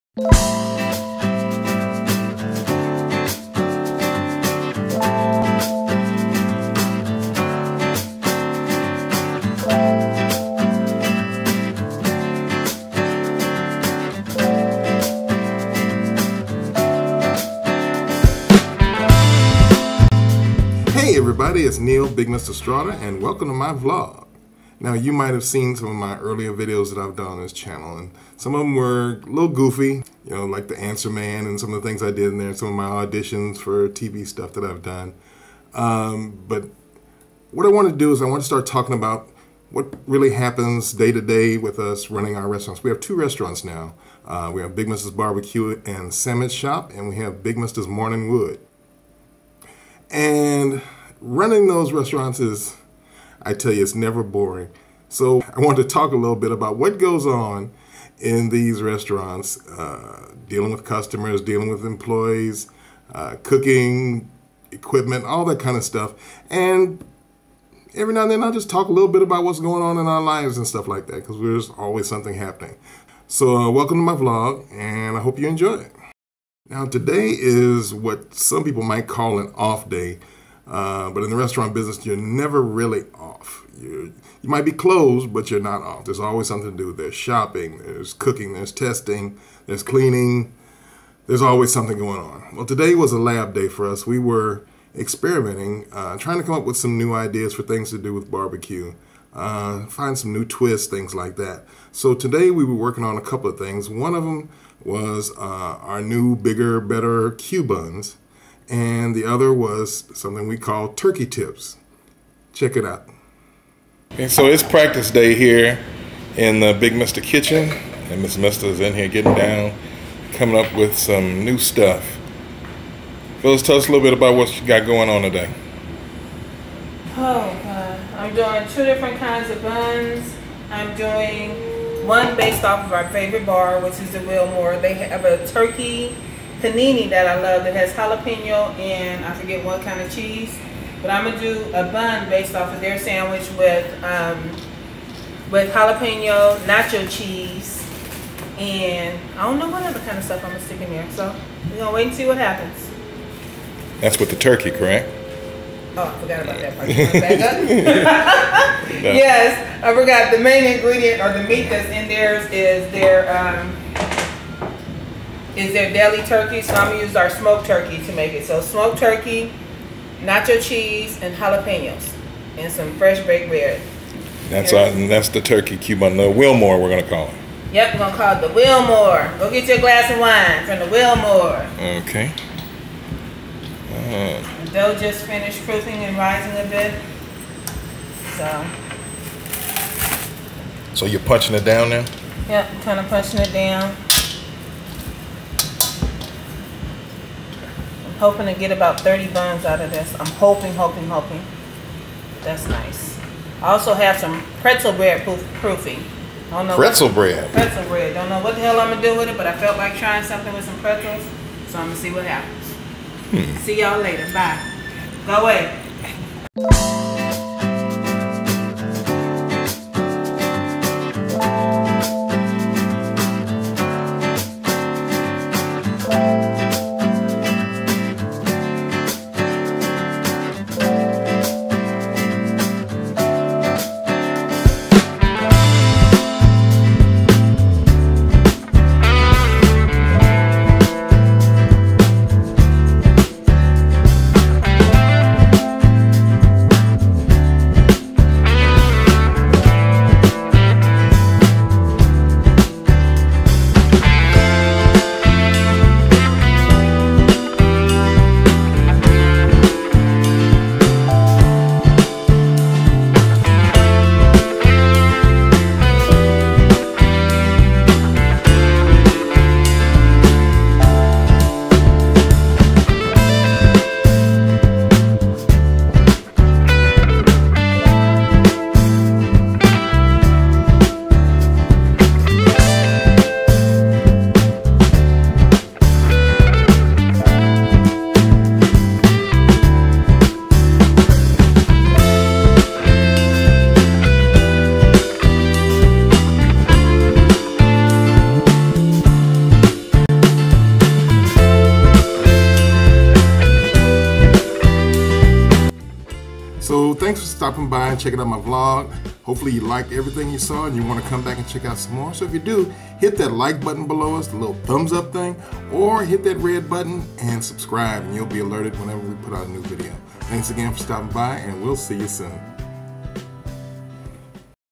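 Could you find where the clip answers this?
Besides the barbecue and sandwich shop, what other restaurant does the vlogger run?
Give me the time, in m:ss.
0:47.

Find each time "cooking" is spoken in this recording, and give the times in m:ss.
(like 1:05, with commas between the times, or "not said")
1:03, 1:28.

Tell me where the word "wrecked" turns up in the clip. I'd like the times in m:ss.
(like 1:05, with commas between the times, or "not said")
not said.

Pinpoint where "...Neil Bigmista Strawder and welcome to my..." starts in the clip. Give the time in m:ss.
0:21.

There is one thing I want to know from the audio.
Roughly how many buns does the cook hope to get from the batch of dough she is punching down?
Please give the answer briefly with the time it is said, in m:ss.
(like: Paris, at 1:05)
30, at 3:18.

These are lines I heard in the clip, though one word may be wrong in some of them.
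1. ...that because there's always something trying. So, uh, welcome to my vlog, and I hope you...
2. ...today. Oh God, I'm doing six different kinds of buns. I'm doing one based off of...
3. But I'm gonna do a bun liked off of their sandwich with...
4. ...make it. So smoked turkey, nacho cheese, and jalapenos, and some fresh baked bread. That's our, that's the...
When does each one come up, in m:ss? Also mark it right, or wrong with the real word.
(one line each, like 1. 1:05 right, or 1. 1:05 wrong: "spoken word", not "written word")
1. 1:11 wrong: "happening", not "trying"
2. 2:05 wrong: "two", not "six"
3. 2:21 wrong: "based", not "liked"
4. 2:48 right.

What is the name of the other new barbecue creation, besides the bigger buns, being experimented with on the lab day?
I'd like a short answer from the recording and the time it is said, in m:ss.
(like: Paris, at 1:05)
turkey tips, at 1:50.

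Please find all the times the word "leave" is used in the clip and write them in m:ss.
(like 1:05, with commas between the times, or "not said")
not said.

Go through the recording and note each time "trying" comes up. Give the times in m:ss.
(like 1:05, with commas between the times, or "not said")
1:36, 3:29.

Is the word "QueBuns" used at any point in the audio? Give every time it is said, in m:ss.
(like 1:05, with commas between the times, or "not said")
1:47, 2:55.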